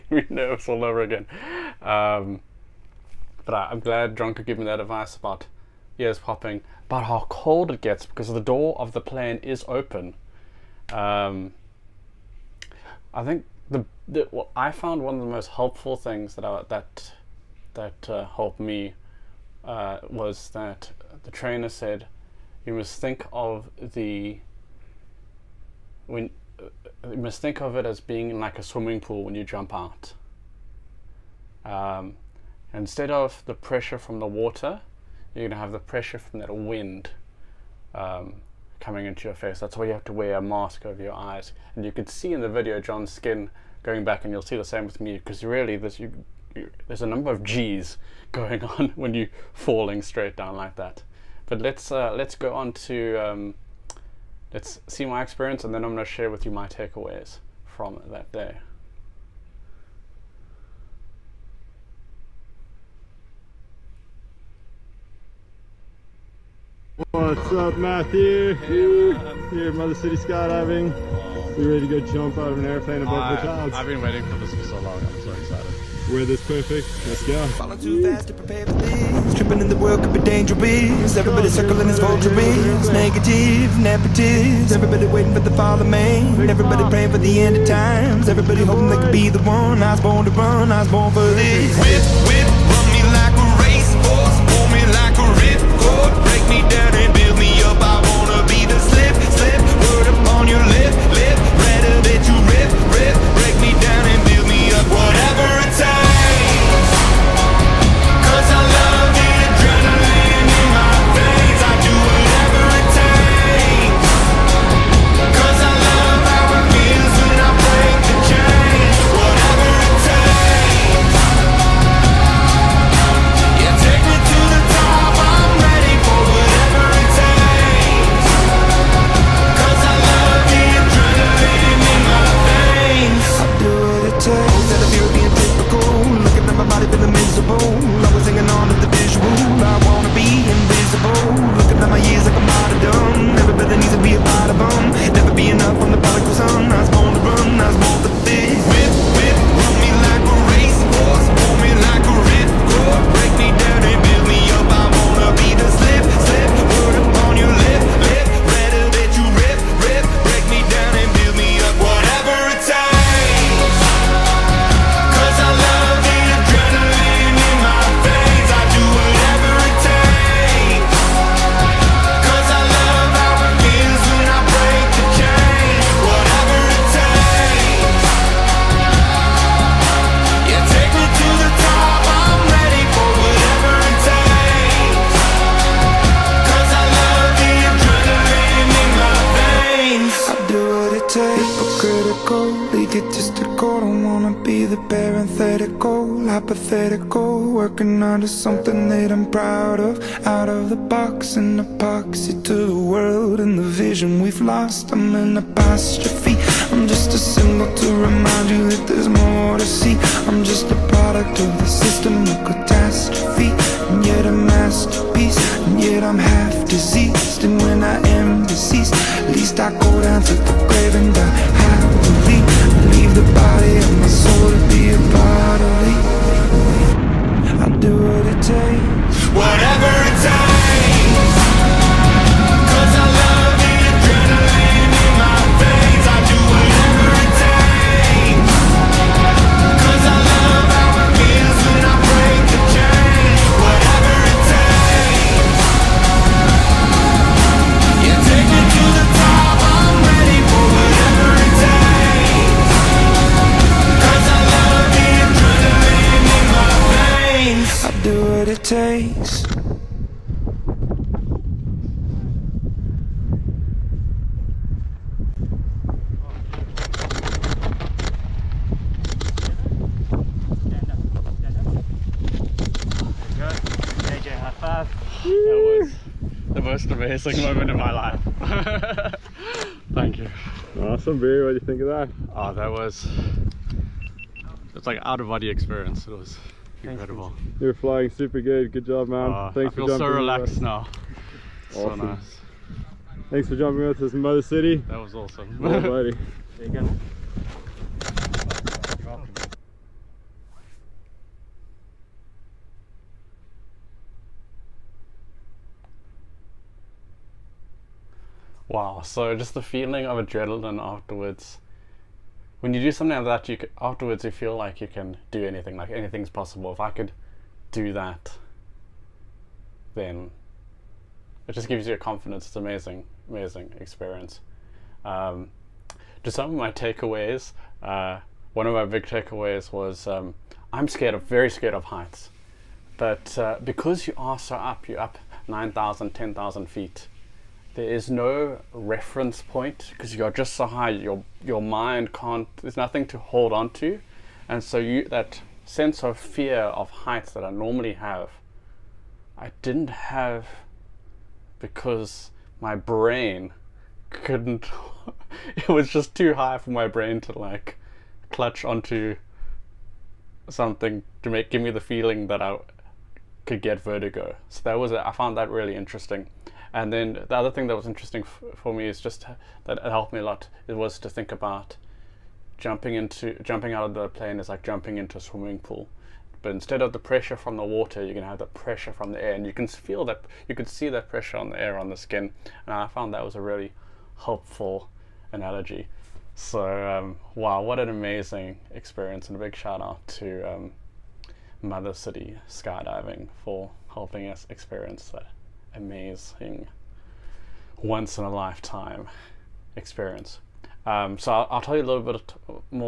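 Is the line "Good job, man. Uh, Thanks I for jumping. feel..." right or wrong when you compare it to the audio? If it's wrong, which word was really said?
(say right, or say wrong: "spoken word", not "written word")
right.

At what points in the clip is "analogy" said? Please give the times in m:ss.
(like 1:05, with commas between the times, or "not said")
6:25.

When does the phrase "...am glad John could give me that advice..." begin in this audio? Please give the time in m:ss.
0:03.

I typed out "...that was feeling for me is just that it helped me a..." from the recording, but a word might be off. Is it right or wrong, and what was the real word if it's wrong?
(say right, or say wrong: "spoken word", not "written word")
wrong: "interesting", not "feeling".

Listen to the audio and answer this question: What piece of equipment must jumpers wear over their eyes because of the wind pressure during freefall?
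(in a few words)
mask.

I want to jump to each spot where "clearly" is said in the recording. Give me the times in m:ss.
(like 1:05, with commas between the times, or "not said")
not said.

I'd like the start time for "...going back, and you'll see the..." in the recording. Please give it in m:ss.
0:43.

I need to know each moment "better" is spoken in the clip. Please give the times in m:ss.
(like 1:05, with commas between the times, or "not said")
not said.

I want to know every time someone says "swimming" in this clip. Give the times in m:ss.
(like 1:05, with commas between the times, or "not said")
0:28, 6:15.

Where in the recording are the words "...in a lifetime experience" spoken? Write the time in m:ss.
6:38.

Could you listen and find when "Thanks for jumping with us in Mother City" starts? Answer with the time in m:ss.
4:53.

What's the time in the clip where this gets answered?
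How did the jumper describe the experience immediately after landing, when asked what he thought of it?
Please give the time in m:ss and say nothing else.
4:45.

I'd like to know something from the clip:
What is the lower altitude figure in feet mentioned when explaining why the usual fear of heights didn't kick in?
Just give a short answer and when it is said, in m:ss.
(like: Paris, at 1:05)
9,000, at 5:35.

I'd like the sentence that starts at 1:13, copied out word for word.
I've been waiting for this for so long.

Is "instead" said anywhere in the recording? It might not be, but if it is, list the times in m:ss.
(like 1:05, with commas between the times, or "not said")
0:32, 6:16.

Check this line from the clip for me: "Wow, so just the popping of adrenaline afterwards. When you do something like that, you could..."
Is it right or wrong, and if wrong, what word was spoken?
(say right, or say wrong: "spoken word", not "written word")
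wrong: "feeling", not "popping".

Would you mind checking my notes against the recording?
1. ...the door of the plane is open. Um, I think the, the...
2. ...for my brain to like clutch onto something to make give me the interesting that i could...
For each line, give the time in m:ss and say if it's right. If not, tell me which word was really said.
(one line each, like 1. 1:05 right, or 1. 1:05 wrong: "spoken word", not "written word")
1. 0:08 right
2. 5:56 wrong: "feeling", not "interesting".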